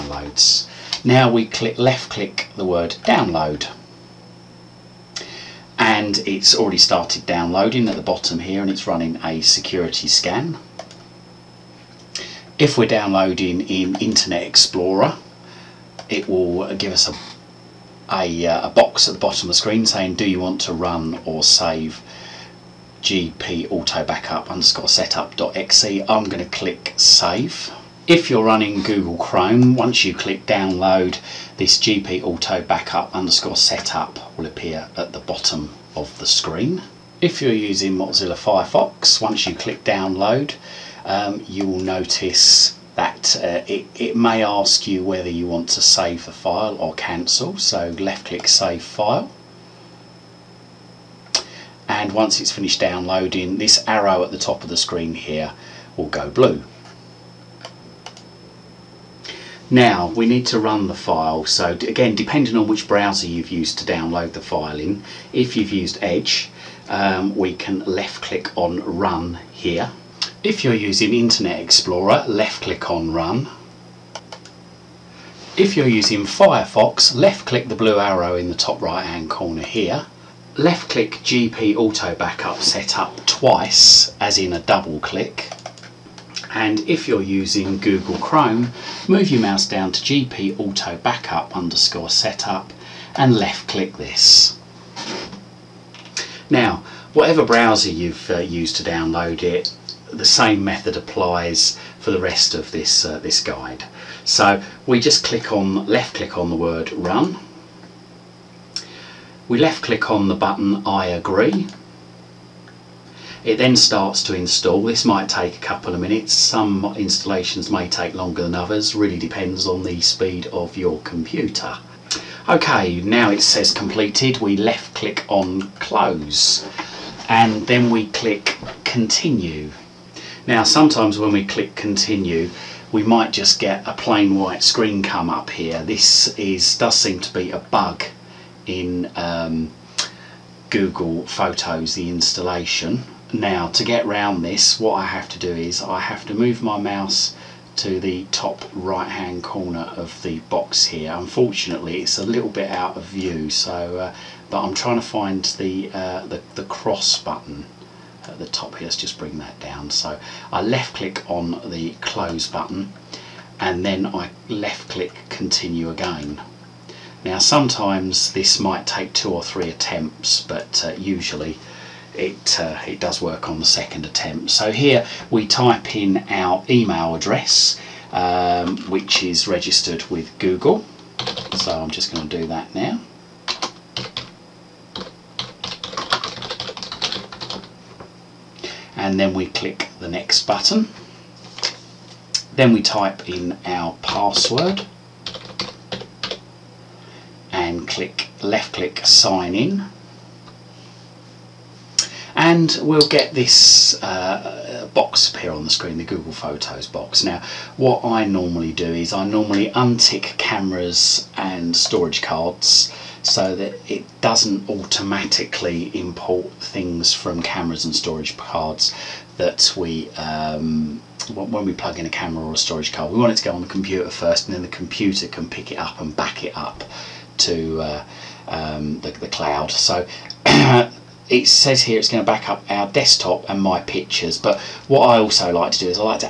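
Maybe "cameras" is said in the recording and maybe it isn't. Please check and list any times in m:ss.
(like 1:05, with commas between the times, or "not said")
3:30, 3:37, 3:42.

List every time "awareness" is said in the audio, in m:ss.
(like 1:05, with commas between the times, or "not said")
not said.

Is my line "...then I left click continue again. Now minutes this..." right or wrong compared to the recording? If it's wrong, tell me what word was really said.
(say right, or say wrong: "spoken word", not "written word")
wrong: "sometimes", not "minutes".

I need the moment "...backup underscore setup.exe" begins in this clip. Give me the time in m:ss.
0:24.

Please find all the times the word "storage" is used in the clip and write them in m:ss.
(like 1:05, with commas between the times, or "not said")
3:31, 3:37, 3:42.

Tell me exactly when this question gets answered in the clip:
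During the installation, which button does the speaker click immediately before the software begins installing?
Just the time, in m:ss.
1:50.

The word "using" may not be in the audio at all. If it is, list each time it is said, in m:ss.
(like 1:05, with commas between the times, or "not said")
0:37, 1:10, 1:15, 1:27.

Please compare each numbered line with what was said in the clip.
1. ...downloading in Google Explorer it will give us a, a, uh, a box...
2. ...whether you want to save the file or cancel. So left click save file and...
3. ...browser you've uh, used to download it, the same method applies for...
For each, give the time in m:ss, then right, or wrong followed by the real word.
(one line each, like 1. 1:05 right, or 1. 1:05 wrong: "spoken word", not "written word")
1. 0:12 wrong: "Internet", not "Google"
2. 0:45 right
3. 1:37 right.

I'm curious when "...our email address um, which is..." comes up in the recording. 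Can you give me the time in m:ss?
2:56.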